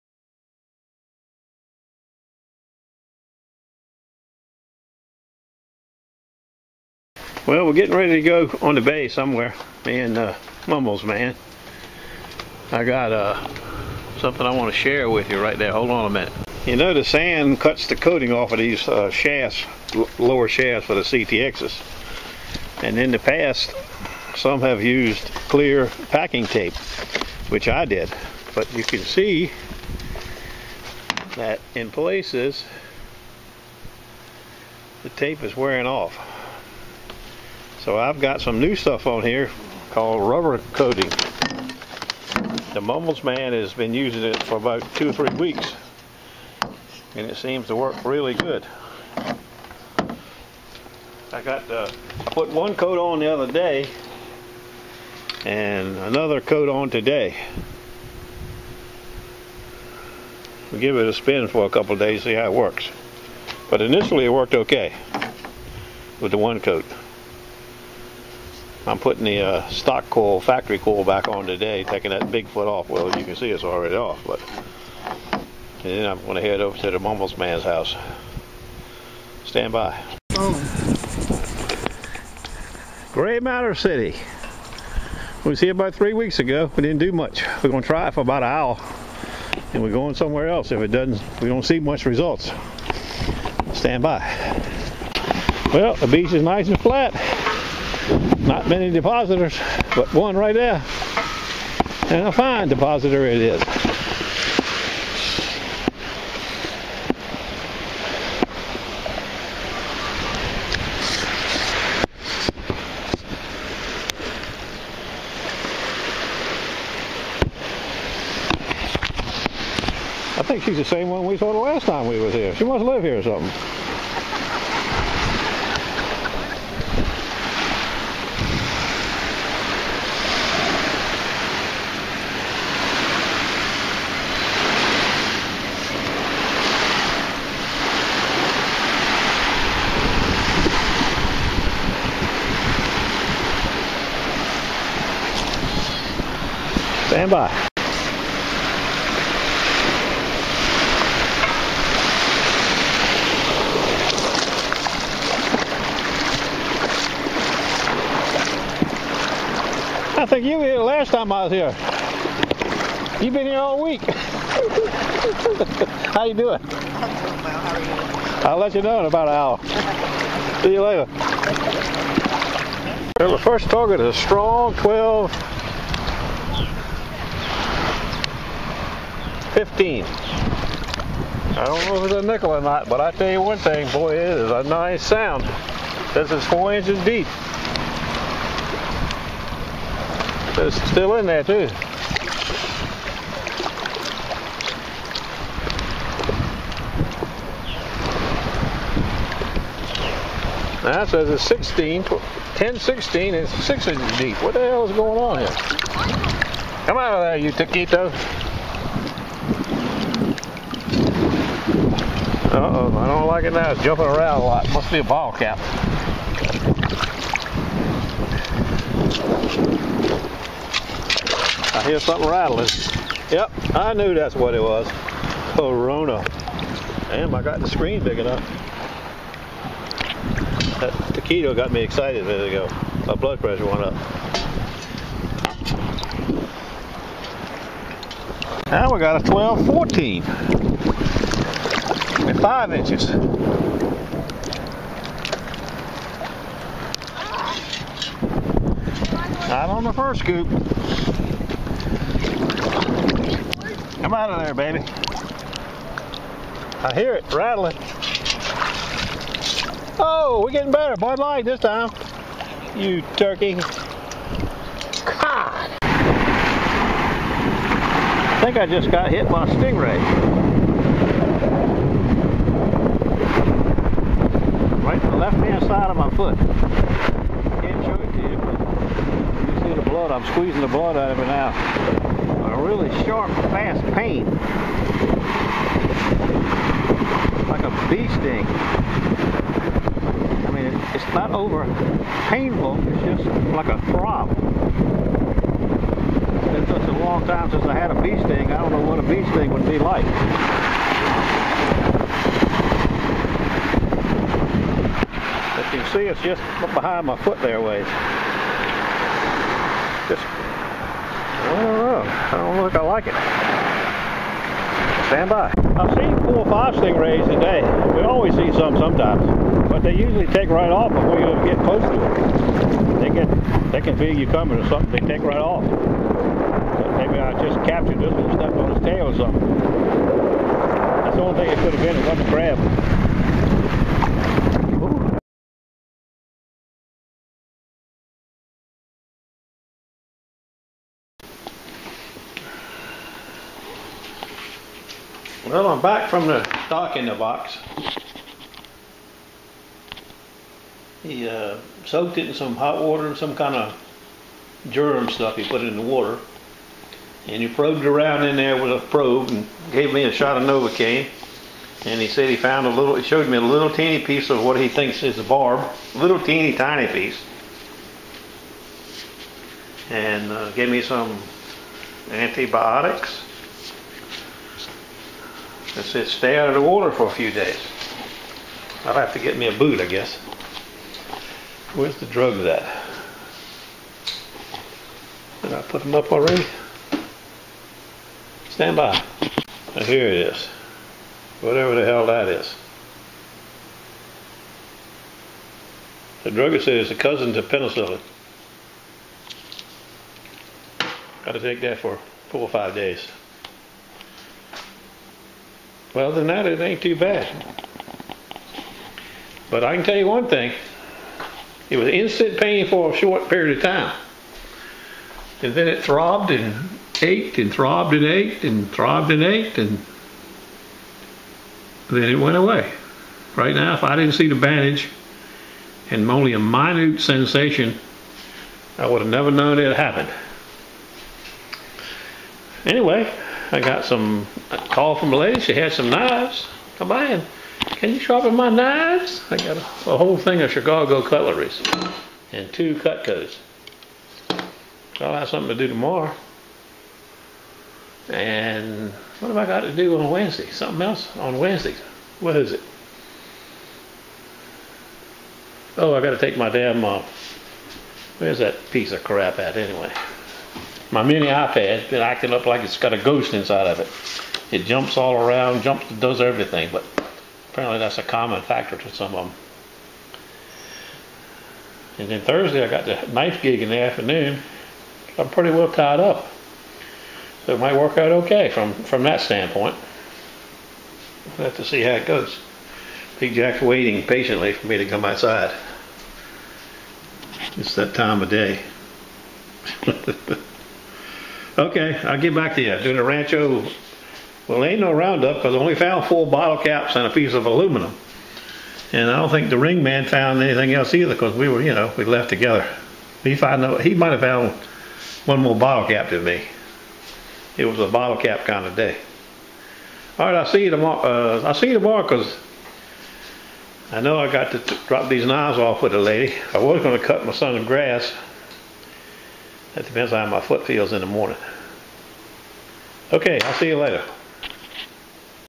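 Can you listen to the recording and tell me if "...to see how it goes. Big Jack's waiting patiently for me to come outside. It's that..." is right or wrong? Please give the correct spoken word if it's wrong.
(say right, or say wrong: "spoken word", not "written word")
right.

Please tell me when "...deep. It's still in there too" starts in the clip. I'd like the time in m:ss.
3:07.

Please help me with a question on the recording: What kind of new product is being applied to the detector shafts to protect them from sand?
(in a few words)
rubber coating.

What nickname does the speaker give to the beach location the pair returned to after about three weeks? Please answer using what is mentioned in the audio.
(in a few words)
Gray Matter City.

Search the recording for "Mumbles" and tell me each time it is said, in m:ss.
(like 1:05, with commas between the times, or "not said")
0:10, 0:42, 1:16.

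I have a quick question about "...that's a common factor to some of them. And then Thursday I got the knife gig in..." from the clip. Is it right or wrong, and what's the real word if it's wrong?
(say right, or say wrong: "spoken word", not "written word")
right.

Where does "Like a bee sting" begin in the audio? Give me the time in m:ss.
4:47.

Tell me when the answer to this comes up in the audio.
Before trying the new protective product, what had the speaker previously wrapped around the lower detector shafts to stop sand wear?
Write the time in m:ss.
0:25.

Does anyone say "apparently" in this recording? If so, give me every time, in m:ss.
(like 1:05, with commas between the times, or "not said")
7:47.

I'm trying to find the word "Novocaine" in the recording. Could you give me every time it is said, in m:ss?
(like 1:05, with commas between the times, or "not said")
6:00.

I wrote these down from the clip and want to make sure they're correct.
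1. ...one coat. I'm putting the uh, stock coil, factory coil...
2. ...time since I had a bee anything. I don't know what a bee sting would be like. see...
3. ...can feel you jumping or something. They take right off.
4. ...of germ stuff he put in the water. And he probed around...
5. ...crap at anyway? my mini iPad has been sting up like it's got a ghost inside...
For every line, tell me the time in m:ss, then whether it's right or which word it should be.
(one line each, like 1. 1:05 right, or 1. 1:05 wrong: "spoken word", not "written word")
1. 1:06 right
2. 4:57 wrong: "sting", not "anything"
3. 5:23 wrong: "coming", not "jumping"
4. 5:53 right
5. 7:39 wrong: "acting", not "sting".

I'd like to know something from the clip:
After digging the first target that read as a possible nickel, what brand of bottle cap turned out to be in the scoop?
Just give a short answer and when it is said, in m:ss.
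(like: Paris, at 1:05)
Corona, at 3:45.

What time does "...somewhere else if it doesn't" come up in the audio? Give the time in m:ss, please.
1:30.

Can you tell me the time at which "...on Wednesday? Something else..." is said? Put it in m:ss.
7:29.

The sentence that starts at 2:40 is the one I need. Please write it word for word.
I think you were here last time I was here.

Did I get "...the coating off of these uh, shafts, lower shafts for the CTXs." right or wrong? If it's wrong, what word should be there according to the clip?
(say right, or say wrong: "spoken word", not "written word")
right.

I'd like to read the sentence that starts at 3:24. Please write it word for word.
What the hell is going on here?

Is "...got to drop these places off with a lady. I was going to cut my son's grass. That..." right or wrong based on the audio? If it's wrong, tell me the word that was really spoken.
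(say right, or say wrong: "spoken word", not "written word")
wrong: "knives", not "places".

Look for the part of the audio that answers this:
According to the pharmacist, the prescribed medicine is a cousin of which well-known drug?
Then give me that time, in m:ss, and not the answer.
6:37.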